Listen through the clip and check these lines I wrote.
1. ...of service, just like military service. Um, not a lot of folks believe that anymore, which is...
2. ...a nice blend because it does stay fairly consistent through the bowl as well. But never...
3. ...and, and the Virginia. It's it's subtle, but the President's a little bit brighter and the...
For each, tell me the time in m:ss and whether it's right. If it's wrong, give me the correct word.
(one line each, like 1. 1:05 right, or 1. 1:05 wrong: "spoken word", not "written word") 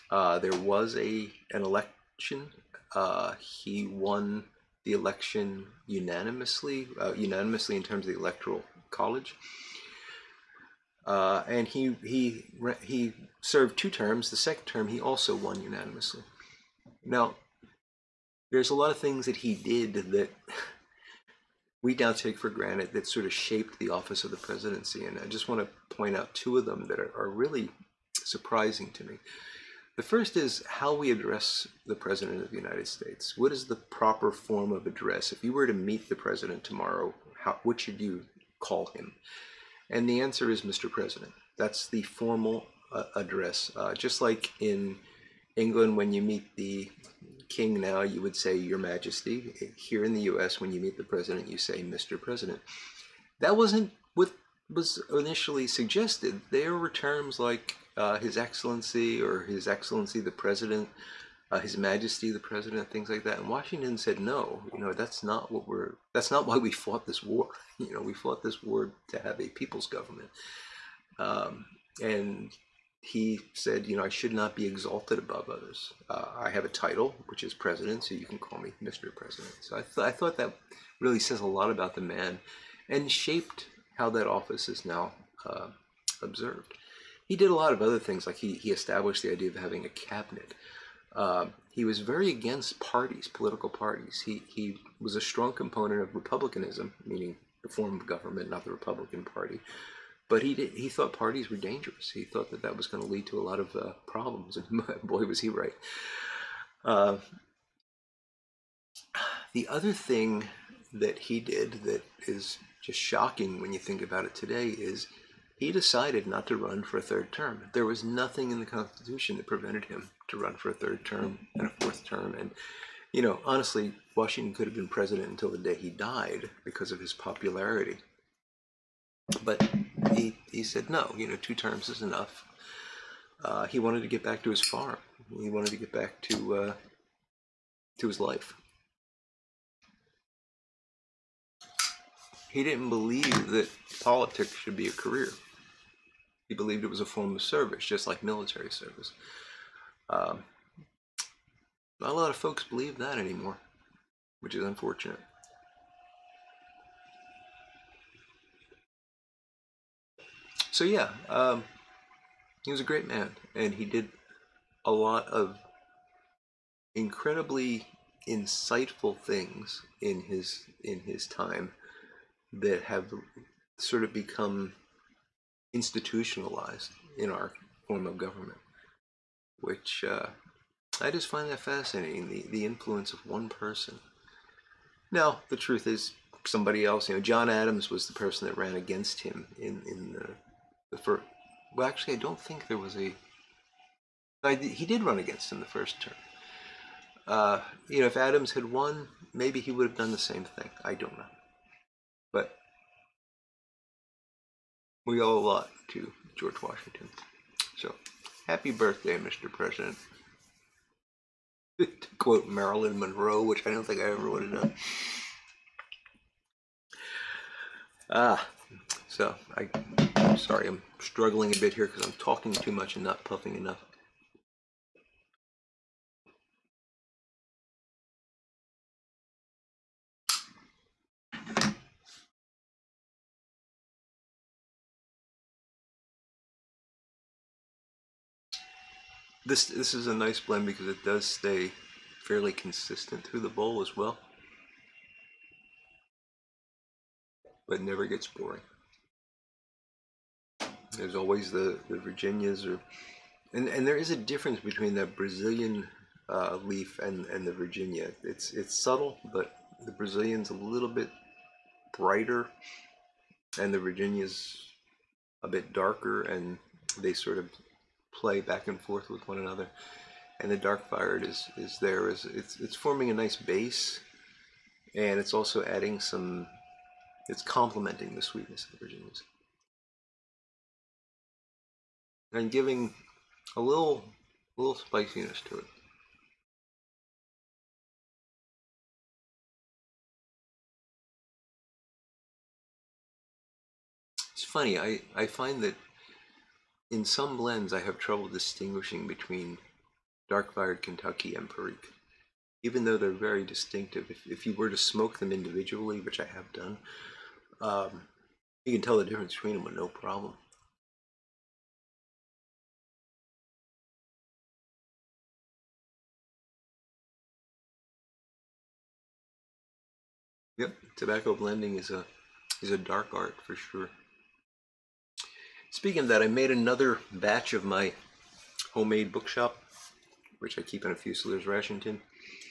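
1. 2:27 right
2. 4:00 right
3. 4:16 wrong: "Brazilian", not "President".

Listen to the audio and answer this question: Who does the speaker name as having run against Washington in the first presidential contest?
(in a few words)
John Adams.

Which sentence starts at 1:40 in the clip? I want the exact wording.
But he did, he thought parties were dangerous.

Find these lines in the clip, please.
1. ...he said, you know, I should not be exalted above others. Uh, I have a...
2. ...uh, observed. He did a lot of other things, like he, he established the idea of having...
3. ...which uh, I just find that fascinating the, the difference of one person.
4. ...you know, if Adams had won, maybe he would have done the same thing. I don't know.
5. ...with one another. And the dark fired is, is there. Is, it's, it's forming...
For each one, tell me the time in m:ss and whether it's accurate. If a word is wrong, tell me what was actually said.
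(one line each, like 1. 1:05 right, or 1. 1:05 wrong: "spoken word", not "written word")
1. 1:13 right
2. 1:25 right
3. 2:59 wrong: "influence", not "difference"
4. 3:17 right
5. 4:29 right.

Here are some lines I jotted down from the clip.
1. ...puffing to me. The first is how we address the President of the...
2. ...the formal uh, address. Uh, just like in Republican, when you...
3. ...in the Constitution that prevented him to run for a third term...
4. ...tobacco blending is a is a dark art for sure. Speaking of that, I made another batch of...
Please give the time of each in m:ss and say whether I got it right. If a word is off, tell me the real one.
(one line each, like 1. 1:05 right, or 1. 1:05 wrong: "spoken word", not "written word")
1. 0:28 wrong: "surprising", not "puffing"
2. 0:41 wrong: "England", not "Republican"
3. 1:58 right
4. 5:20 right.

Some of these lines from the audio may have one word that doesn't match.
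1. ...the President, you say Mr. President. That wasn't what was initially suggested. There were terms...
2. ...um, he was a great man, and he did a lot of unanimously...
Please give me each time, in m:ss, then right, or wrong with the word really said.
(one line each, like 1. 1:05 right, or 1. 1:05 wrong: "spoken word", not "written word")
1. 0:50 right
2. 2:41 wrong: "incredibly", not "unanimously".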